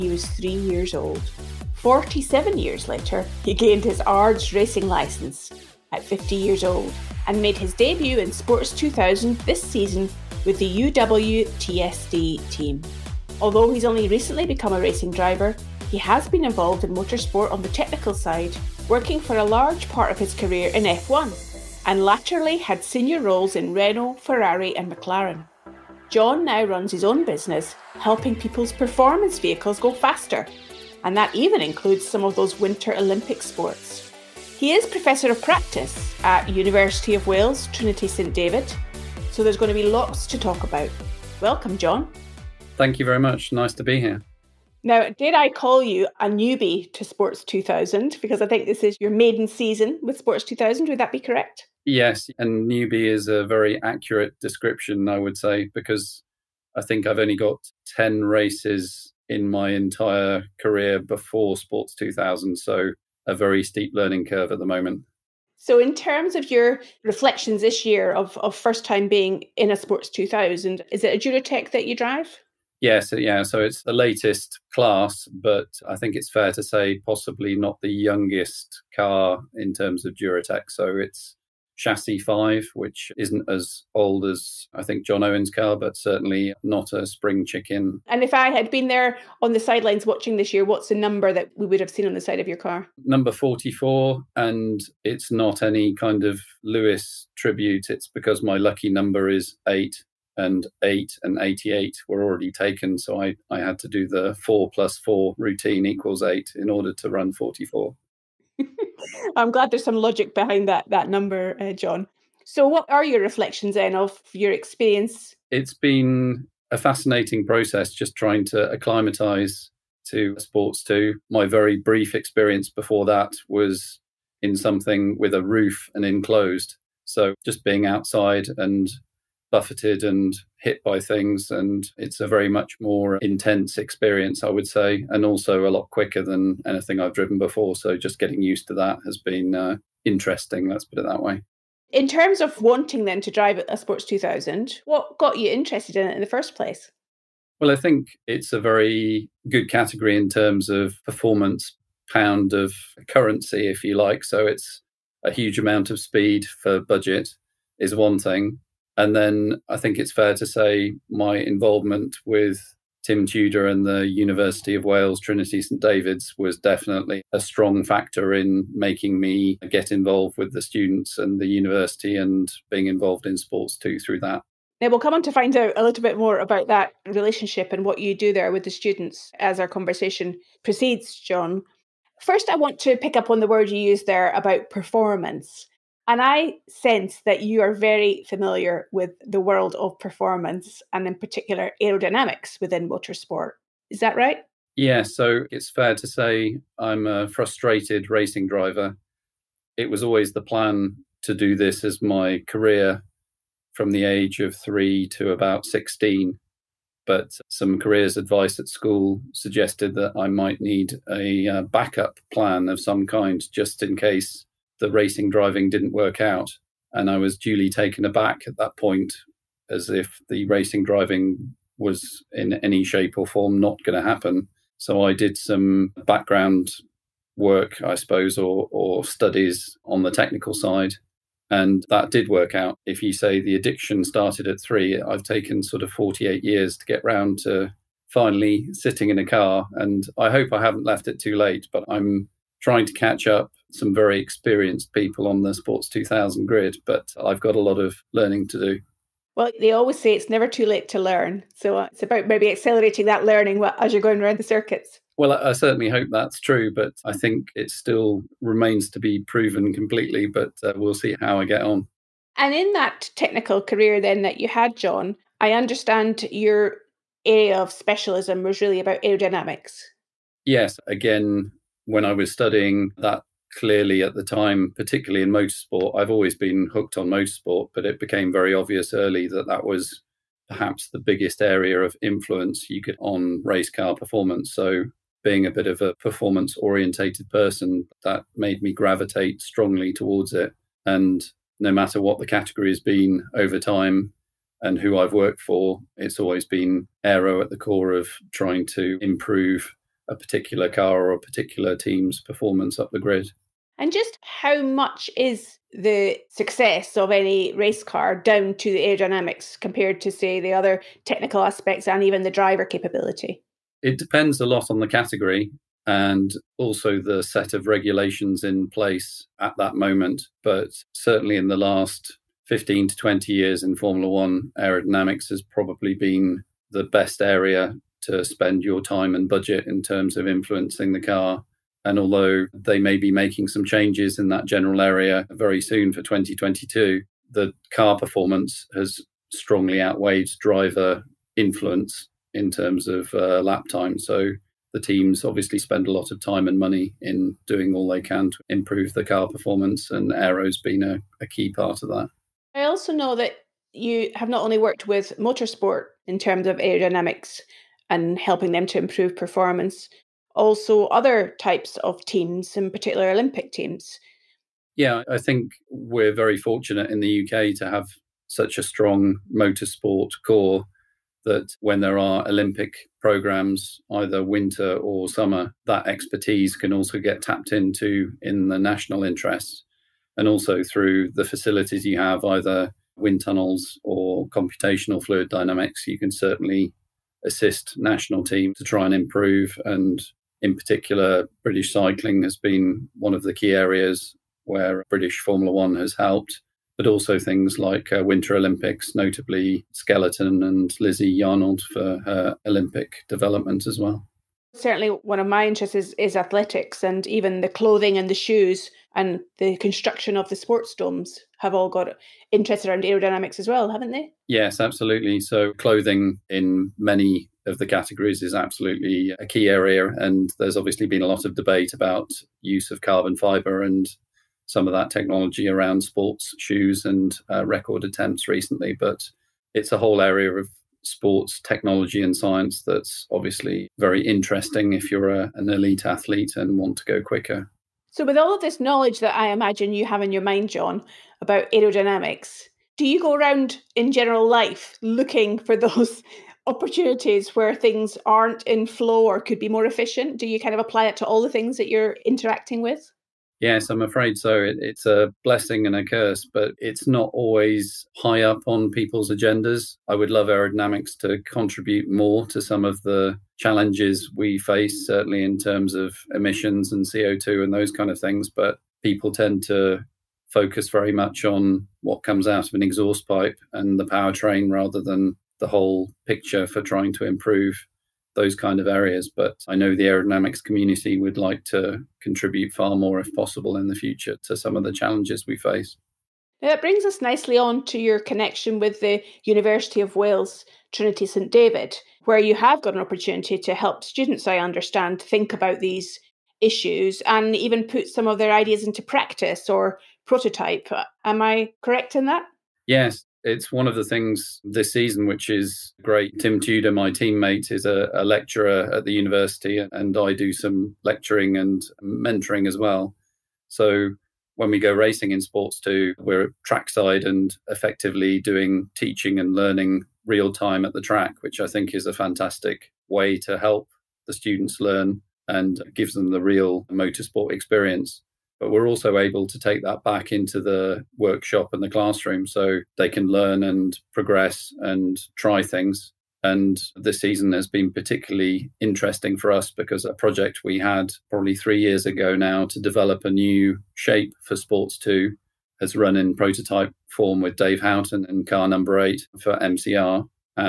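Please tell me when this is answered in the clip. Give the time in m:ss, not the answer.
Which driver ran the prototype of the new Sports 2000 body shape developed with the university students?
9:07.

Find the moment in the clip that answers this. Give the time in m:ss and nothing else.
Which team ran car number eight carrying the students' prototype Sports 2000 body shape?
9:09.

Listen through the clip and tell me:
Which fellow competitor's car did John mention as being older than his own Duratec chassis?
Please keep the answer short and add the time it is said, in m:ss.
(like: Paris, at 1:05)
John Owen, at 1:25.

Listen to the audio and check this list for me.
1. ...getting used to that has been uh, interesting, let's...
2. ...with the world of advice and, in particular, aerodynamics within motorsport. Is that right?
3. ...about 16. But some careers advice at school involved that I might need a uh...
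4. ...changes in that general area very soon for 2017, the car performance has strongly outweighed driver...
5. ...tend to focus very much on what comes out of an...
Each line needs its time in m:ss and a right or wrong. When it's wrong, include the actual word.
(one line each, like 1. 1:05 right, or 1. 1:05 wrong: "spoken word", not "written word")
1. 2:18 right
2. 3:08 wrong: "performance", not "advice"
3. 3:25 wrong: "suggested", not "involved"
4. 5:33 wrong: "2022", not "2017"
5. 7:49 right.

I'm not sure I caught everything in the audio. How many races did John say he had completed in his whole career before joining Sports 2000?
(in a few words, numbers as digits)
10.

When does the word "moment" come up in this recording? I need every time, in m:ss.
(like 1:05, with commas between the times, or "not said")
1:04, 5:19.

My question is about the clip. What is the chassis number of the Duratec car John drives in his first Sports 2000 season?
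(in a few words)
5.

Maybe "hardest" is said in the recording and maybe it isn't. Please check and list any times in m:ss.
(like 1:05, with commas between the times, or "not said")
not said.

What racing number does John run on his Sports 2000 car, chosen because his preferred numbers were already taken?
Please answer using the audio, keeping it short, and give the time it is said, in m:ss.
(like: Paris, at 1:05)
44, at 1:33.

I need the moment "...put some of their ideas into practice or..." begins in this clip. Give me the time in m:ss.
8:17.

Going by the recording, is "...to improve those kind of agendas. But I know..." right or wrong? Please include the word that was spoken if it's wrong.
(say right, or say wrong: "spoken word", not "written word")
wrong: "areas", not "agendas".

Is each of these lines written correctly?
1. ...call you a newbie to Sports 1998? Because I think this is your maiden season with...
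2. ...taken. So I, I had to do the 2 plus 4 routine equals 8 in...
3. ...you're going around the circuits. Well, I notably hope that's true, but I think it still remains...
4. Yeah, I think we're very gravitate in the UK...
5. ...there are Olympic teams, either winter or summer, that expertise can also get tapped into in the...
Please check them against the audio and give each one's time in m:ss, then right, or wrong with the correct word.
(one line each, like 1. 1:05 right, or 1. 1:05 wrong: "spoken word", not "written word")
1. 0:45 wrong: "2000", not "1998"
2. 1:42 wrong: "4", not "2"
3. 4:13 wrong: "certainly", not "notably"
4. 6:04 wrong: "fortunate", not "gravitate"
5. 6:11 wrong: "programs", not "teams".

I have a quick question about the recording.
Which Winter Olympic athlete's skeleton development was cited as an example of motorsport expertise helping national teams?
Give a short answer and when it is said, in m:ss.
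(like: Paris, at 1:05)
Lizzie Yarnold, at 6:40.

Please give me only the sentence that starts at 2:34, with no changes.
So it's a huge amount of speed for budget is one thing.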